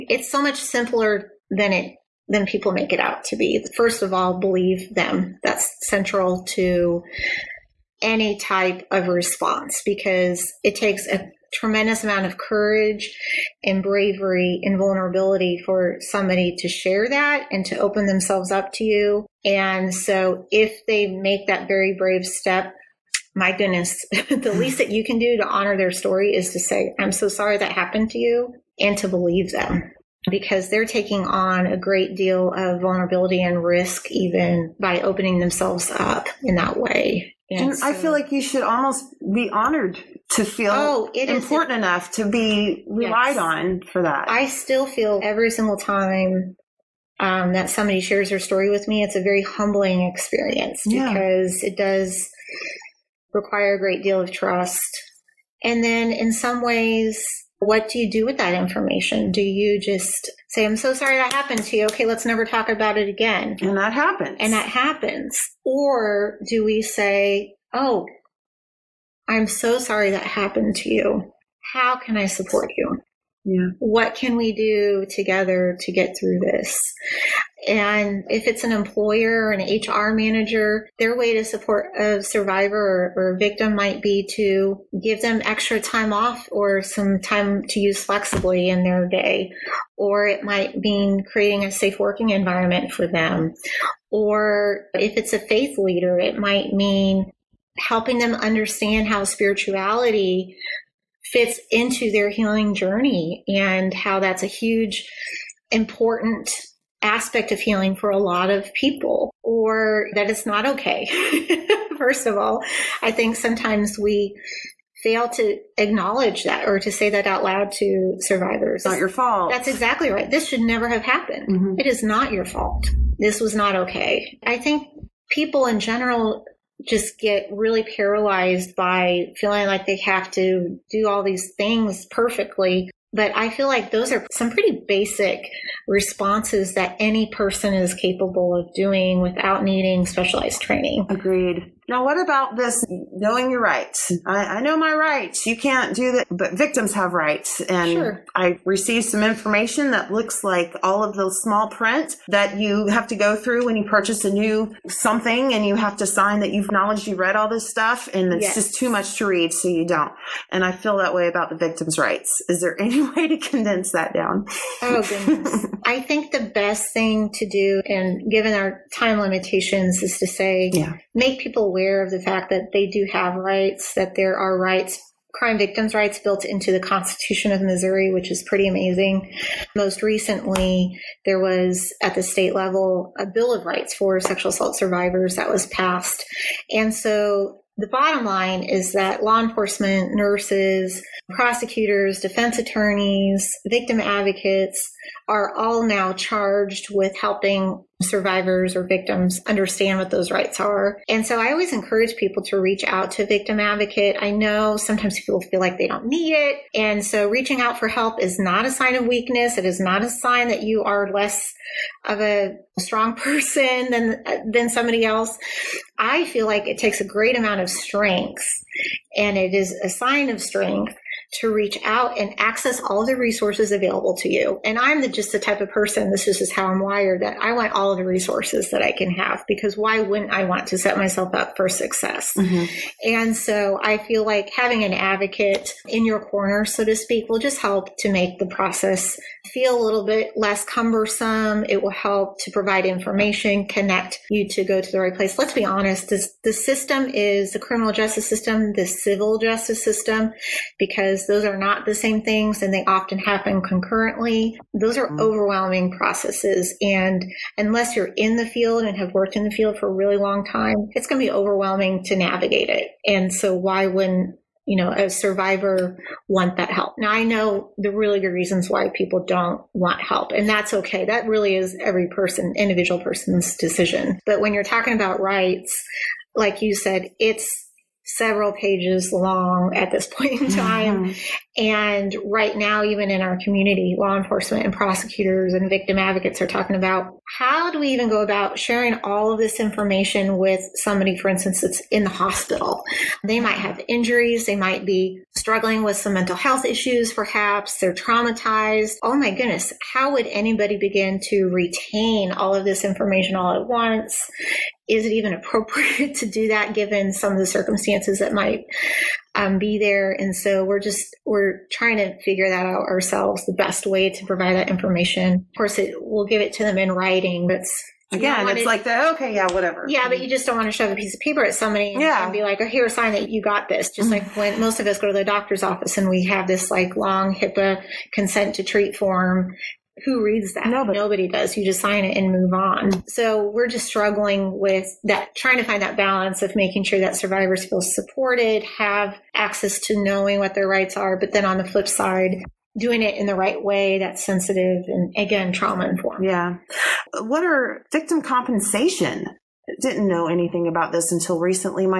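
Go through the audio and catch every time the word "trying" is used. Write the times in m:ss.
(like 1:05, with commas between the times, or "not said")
5:11, 5:35.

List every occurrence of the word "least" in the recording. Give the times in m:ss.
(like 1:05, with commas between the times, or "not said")
0:24.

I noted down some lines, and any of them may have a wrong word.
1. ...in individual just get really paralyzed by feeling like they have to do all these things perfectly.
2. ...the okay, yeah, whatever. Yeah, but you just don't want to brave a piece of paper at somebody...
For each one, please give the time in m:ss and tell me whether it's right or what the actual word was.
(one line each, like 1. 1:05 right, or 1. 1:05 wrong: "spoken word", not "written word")
1. 2:05 wrong: "general", not "individual"
2. 5:18 wrong: "shove", not "brave".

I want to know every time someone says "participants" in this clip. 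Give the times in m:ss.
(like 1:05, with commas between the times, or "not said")
not said.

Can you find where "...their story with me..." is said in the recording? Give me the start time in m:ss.
0:48.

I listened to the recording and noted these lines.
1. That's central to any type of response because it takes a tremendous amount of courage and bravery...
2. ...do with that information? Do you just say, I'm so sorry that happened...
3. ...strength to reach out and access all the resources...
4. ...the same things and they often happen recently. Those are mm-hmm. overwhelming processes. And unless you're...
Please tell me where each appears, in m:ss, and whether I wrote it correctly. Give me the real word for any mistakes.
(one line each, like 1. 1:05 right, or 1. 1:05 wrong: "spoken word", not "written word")
1. 0:05 right
2. 0:58 right
3. 3:40 right
4. 4:11 wrong: "concurrently", not "recently".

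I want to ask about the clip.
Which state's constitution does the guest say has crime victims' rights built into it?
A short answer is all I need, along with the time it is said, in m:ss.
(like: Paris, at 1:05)
Missouri, at 2:57.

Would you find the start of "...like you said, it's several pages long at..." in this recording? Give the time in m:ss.
4:36.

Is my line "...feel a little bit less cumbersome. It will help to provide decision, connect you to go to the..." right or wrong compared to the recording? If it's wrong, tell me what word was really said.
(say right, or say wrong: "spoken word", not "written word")
wrong: "information", not "decision".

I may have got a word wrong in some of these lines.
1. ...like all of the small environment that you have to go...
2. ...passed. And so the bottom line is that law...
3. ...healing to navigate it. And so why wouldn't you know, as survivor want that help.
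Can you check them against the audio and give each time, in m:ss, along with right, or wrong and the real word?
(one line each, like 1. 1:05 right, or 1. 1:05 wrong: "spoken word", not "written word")
1. 2:30 wrong: "print", not "environment"
2. 3:05 right
3. 4:21 wrong: "overwhelming", not "healing".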